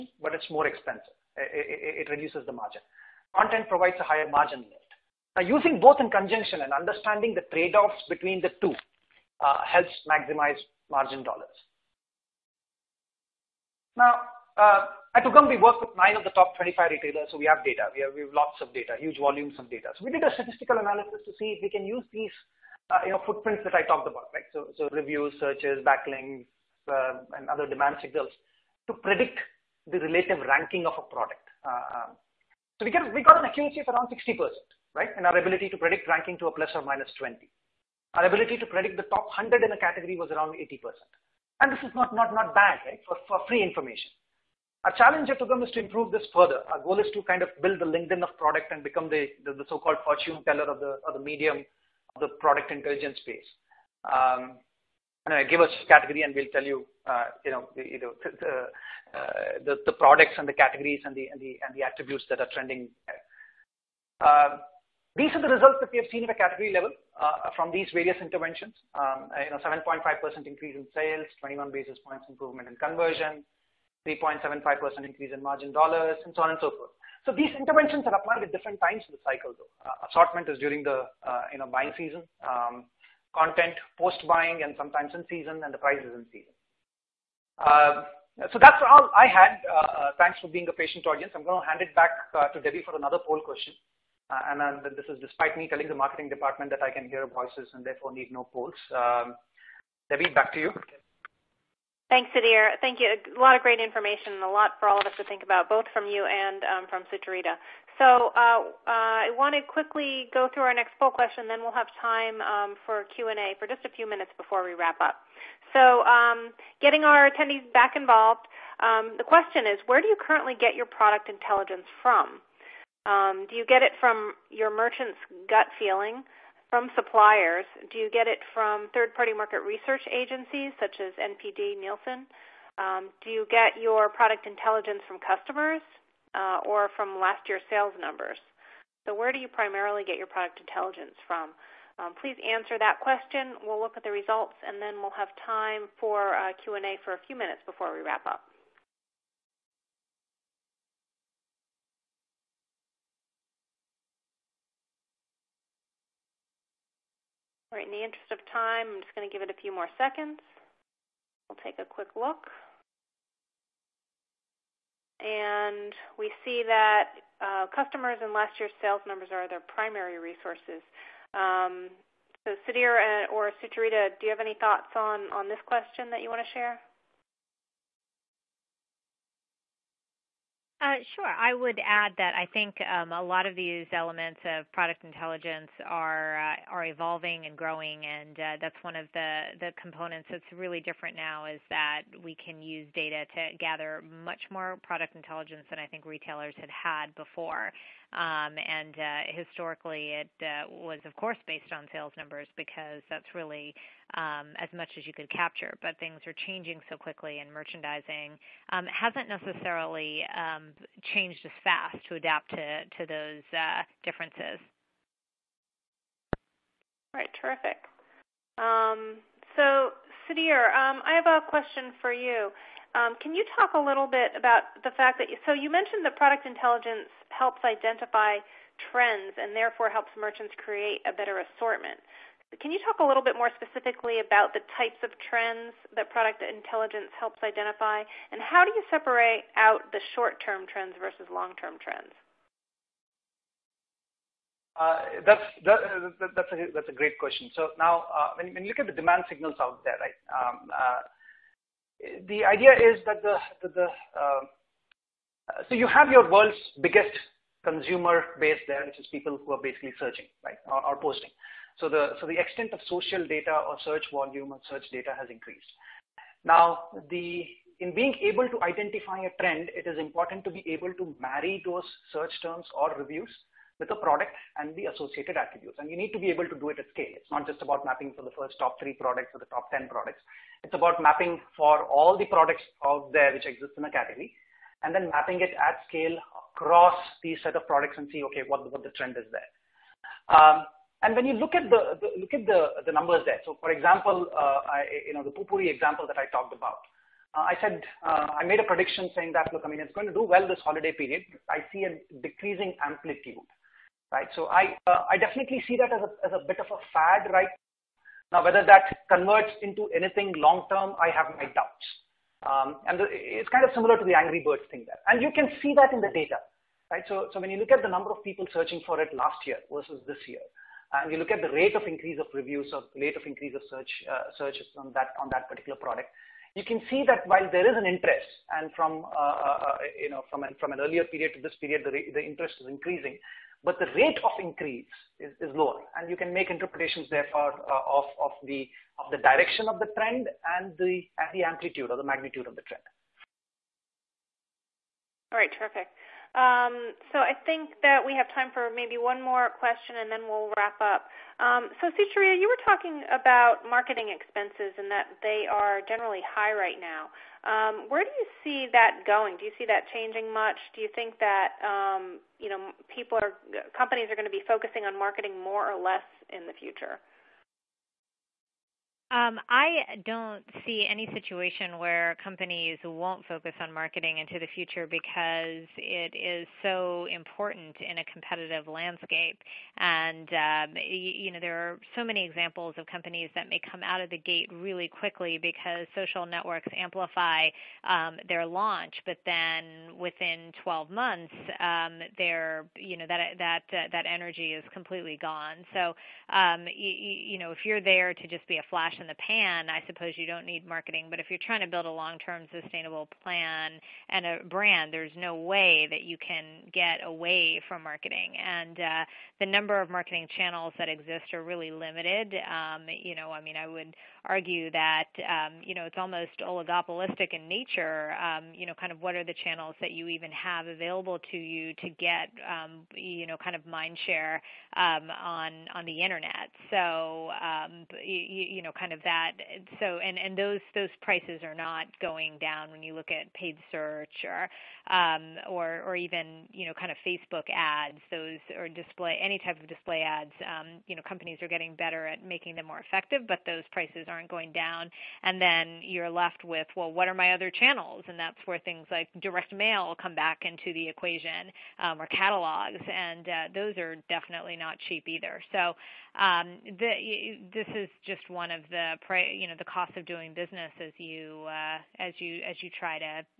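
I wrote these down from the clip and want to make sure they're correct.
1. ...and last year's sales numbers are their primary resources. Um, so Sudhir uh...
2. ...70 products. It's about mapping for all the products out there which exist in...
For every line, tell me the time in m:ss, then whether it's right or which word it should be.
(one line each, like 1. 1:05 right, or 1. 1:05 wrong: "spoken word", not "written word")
1. 2:48 right
2. 4:39 wrong: "10", not "70".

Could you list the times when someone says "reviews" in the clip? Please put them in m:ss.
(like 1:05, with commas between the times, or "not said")
0:24, 4:32, 5:22.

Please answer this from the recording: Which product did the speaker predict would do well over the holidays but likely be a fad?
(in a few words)
Poo-Pourri.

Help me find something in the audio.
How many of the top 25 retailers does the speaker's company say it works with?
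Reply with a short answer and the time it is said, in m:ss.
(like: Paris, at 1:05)
9, at 0:15.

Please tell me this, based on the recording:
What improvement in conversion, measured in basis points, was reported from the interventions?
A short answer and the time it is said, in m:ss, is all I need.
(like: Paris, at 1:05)
21 basis points, at 1:11.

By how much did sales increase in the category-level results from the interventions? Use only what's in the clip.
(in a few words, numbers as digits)
7.5%.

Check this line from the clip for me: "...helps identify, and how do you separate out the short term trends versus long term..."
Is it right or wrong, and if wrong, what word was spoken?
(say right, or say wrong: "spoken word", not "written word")
right.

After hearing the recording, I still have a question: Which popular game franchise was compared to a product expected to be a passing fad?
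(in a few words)
Angry Birds.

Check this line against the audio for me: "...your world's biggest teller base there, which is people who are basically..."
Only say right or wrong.
wrong.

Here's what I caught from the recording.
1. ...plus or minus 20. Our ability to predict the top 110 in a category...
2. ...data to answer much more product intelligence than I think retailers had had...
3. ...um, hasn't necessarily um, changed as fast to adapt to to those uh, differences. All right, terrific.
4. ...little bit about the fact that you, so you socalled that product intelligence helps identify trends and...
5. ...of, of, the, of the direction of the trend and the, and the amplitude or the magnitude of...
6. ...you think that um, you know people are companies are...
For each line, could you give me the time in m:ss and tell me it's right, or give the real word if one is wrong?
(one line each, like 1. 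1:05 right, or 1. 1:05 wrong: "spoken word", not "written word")
1. 0:36 wrong: "100", not "110"
2. 3:12 wrong: "gather", not "answer"
3. 3:28 right
4. 3:43 wrong: "mentioned", not "socalled"
5. 5:37 right
6. 6:00 right.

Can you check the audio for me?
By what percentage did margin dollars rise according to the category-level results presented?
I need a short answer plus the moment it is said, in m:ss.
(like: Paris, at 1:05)
3.75%, at 1:14.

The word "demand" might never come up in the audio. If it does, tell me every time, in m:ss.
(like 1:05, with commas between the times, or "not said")
0:27, 4:08.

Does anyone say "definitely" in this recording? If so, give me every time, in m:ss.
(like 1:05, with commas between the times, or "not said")
5:05, 7:34.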